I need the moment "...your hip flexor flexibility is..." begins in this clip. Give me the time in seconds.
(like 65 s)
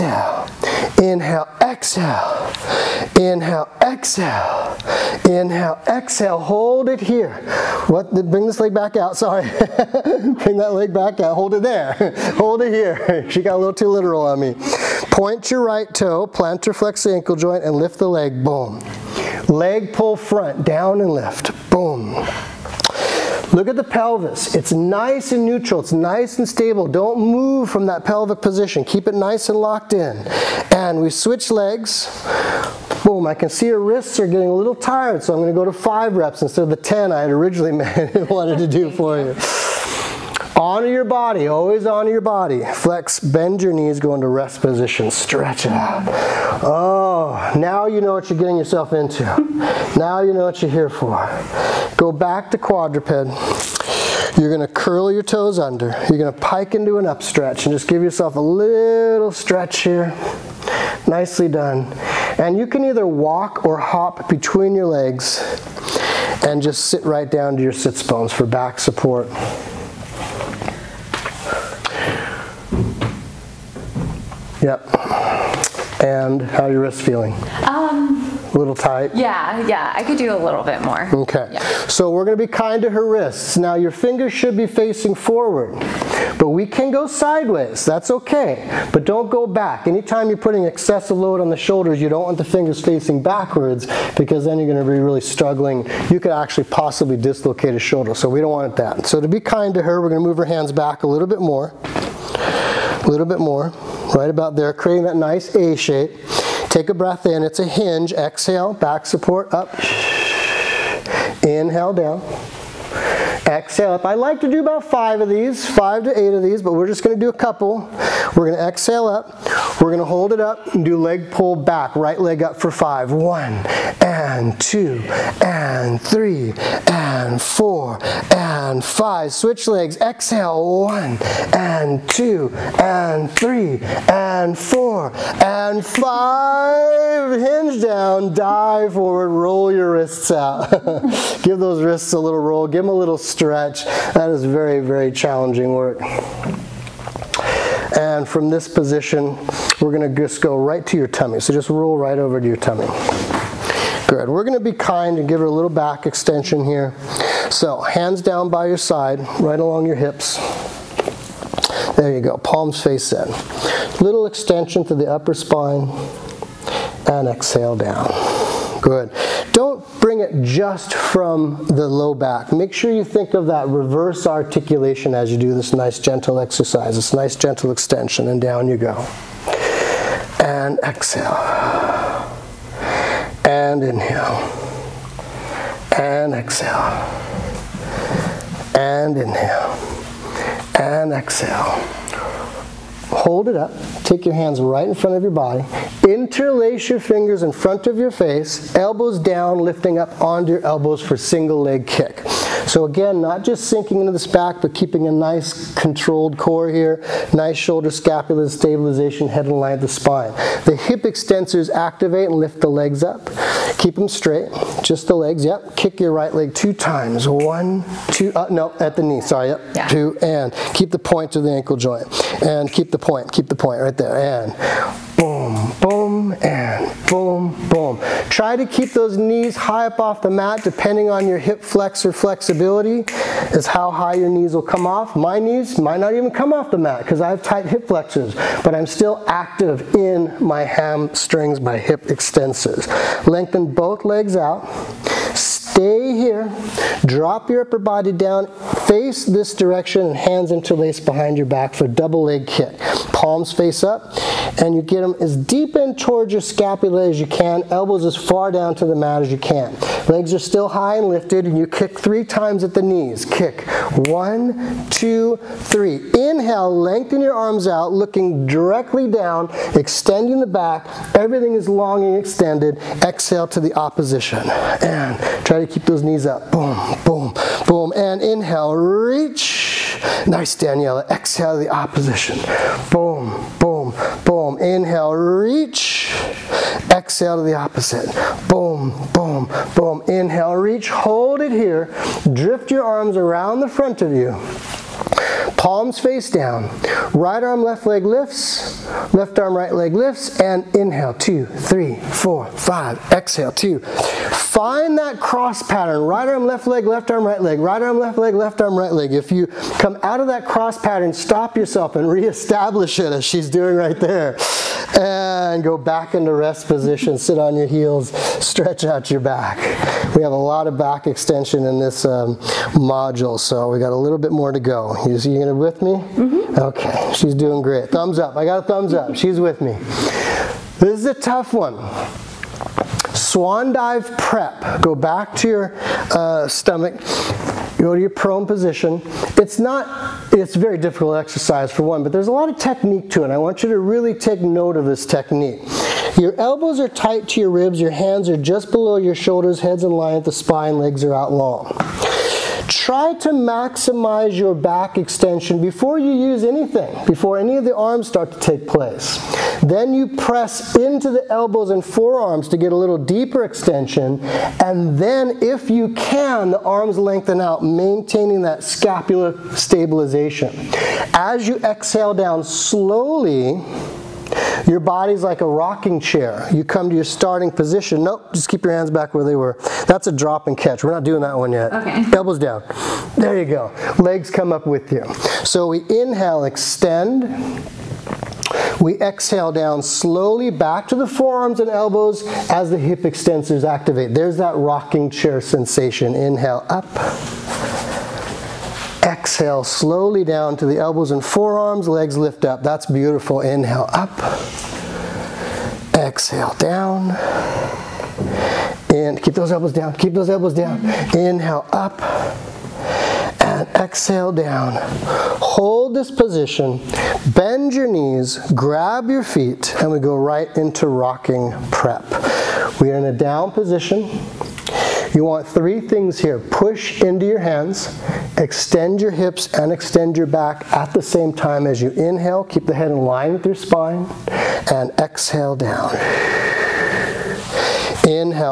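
231 s.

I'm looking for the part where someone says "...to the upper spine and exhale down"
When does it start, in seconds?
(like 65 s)
164 s.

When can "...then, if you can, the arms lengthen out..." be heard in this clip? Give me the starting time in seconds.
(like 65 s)
364 s.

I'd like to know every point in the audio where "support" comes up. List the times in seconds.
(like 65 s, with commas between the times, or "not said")
68 s, 109 s.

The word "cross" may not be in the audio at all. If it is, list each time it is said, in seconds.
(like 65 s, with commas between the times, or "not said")
305 s, 310 s.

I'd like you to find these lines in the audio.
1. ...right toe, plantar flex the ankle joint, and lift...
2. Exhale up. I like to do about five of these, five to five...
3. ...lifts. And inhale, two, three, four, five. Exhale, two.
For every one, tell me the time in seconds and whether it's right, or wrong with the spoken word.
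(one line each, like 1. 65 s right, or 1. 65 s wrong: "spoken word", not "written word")
1. 15 s right
2. 113 s wrong: "eight", not "five"
3. 299 s right.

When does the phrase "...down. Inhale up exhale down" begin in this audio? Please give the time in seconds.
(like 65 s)
410 s.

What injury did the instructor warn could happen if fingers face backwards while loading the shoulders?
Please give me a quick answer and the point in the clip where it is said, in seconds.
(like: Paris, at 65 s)
Dislocate a shoulder, at 97 s.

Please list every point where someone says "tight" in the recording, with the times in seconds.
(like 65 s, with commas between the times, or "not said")
78 s, 237 s, 346 s.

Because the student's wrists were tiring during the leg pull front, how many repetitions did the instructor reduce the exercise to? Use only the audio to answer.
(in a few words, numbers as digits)
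5.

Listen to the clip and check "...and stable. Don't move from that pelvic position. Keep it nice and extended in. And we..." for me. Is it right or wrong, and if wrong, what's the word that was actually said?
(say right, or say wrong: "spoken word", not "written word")
wrong: "locked", not "extended".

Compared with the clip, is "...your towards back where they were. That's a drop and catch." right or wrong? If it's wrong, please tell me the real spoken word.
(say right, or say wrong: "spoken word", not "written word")
wrong: "hands", not "towards".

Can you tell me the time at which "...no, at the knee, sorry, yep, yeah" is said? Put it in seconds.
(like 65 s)
218 s.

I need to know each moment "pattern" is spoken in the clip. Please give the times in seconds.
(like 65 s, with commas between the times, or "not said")
305 s, 310 s.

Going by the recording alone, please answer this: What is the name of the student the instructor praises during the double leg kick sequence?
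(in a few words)
Daniela.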